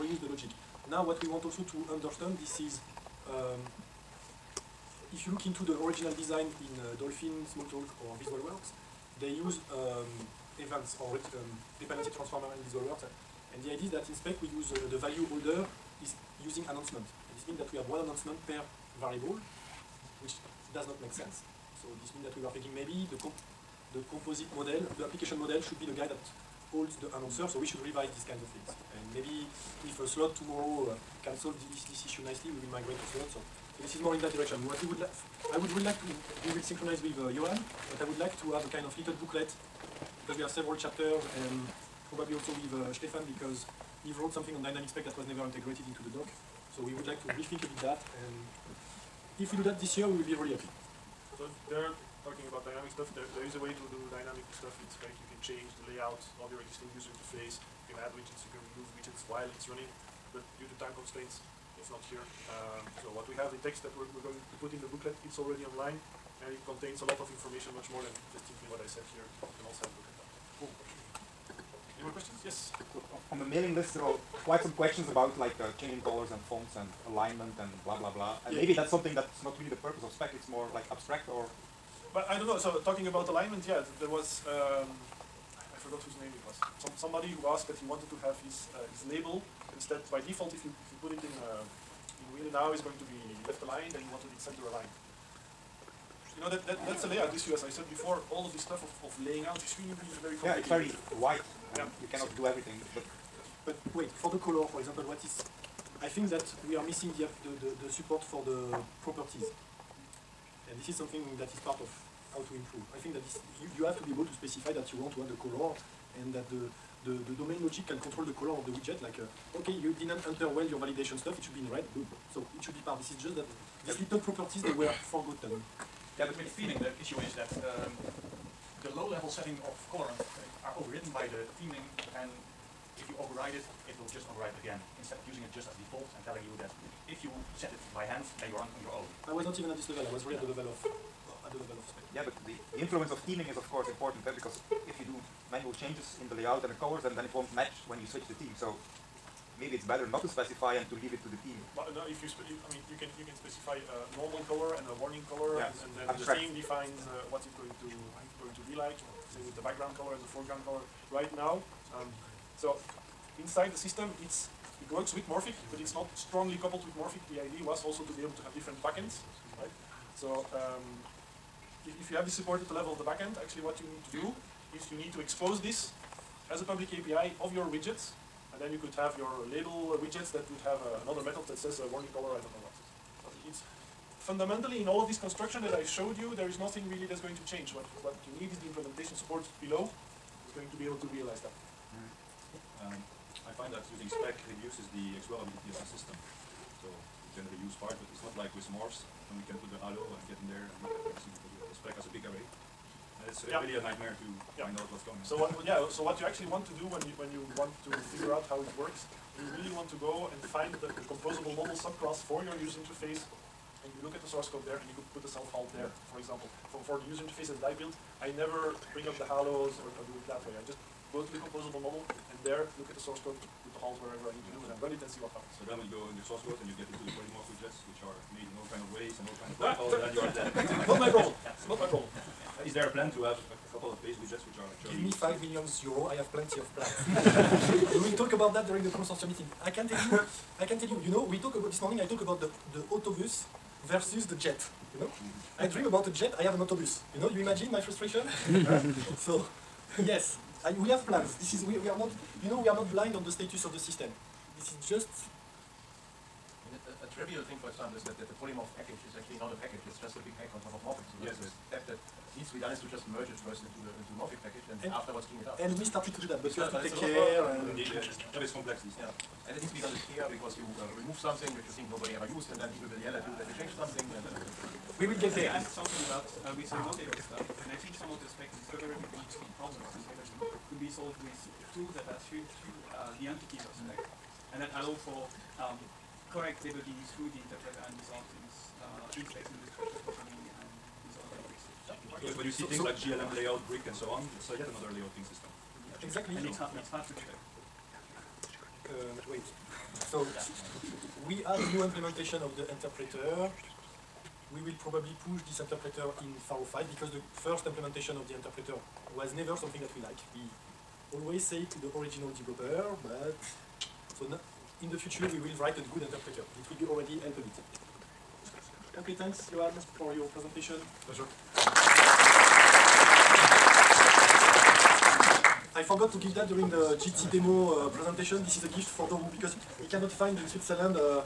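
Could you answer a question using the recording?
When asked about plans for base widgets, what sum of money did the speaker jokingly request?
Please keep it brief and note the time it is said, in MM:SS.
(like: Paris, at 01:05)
5 million euro, at 03:55.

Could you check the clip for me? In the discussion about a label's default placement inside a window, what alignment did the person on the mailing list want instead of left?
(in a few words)
Center aligned.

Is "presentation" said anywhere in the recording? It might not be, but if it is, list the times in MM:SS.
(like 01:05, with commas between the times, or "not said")
05:20, 05:27.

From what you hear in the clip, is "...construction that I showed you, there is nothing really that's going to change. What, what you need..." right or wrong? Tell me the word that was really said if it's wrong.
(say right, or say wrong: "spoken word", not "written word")
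right.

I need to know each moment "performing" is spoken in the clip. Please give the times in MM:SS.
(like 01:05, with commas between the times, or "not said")
not said.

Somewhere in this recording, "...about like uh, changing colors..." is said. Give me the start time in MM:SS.
01:15.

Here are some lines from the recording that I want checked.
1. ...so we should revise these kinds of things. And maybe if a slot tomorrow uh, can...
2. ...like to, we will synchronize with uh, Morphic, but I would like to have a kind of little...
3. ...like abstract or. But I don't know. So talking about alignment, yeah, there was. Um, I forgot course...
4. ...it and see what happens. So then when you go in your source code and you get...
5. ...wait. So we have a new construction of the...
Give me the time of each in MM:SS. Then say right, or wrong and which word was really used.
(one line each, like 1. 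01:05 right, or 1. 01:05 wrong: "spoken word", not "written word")
1. 00:27 right
2. 00:35 wrong: "Johan", not "Morphic"
3. 01:20 wrong: "whose", not "course"
4. 03:44 right
5. 04:59 wrong: "implementation", not "construction".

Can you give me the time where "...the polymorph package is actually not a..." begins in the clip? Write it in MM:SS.
04:18.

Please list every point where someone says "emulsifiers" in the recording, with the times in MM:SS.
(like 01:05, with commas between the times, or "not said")
not said.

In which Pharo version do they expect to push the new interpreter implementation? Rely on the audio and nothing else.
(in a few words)
Pharo 5.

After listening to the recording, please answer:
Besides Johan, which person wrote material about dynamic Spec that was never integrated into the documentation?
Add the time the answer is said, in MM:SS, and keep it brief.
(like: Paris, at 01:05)
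Stefan, at 00:42.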